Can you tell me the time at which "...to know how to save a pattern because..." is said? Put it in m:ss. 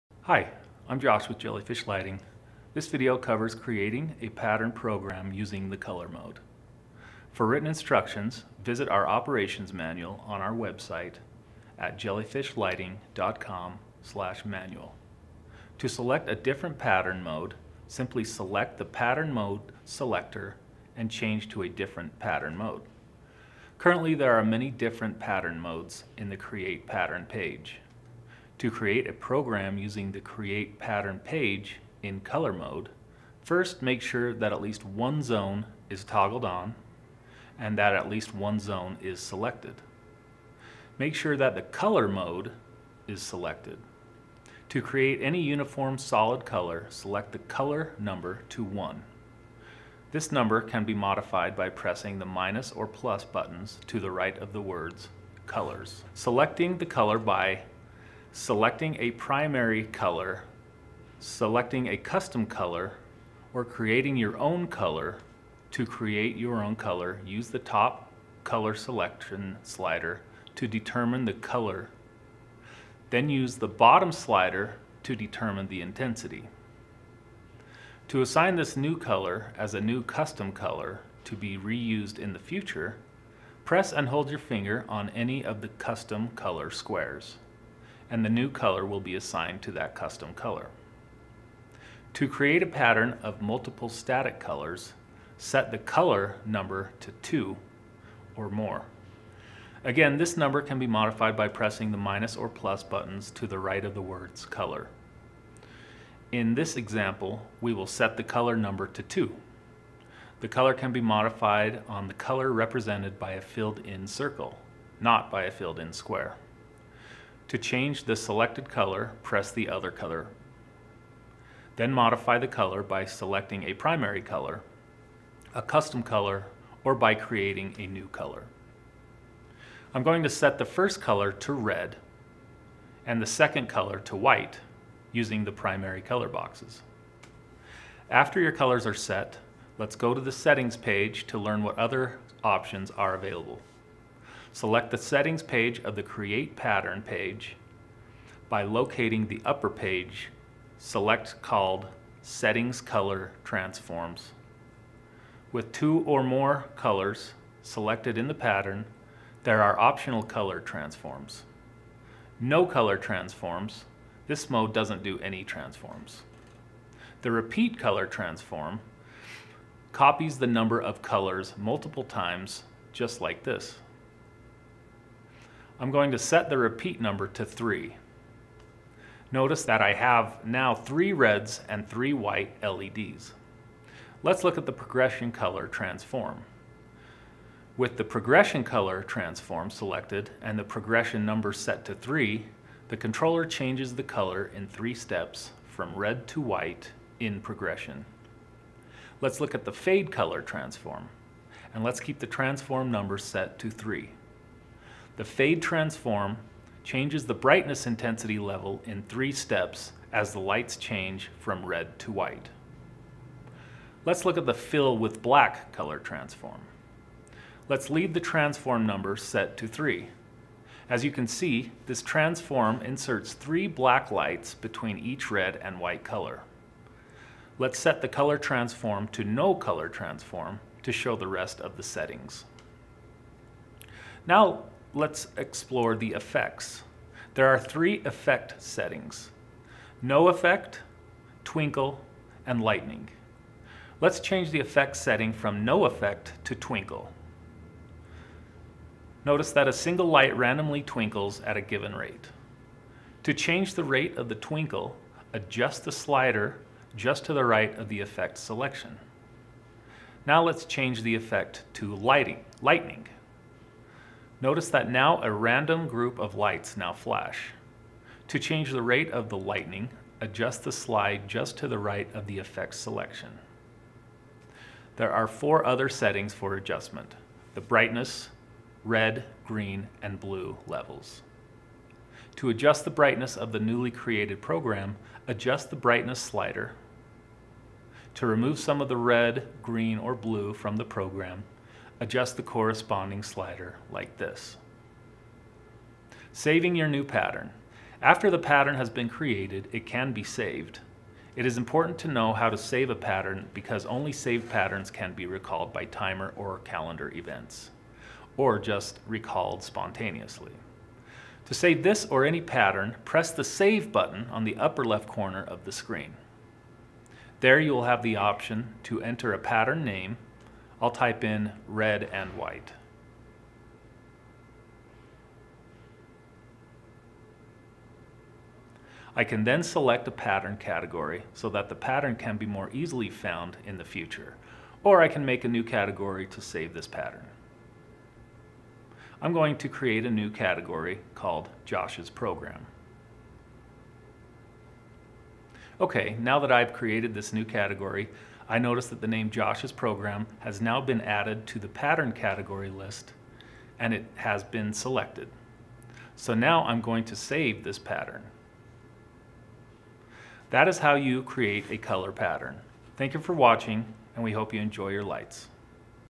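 5:01.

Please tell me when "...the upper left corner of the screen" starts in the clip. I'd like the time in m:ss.
5:14.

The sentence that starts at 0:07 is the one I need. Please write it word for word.
For written instructions, visit our operations manual on our website at jellyfishlighting.com slash manual.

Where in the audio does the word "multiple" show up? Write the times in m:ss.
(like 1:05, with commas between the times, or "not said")
1:33, 2:51.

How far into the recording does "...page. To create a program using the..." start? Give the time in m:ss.
0:27.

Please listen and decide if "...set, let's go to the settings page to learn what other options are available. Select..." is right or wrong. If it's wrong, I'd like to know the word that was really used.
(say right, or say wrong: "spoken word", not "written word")
right.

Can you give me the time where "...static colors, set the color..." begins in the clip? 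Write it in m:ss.
1:33.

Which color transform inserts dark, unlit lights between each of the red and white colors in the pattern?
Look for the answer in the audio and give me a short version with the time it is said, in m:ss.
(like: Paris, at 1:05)
fill with black, at 3:34.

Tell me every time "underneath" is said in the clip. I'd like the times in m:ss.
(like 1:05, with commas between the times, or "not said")
not said.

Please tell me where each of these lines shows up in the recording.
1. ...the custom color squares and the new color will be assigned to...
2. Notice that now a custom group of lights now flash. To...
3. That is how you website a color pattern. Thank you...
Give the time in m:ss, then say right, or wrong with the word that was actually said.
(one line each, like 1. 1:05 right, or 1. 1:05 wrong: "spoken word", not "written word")
1. 1:25 right
2. 4:24 wrong: "random", not "custom"
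3. 6:00 wrong: "create", not "website".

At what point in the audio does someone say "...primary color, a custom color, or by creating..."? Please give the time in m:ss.
2:03.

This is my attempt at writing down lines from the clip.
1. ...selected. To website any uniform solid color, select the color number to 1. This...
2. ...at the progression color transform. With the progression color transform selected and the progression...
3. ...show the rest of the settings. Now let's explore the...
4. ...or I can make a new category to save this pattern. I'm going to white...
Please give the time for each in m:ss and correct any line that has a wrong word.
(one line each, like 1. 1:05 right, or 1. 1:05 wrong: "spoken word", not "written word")
1. 0:43 wrong: "create", not "website"
2. 3:04 right
3. 3:50 right
4. 5:34 wrong: "create", not "white".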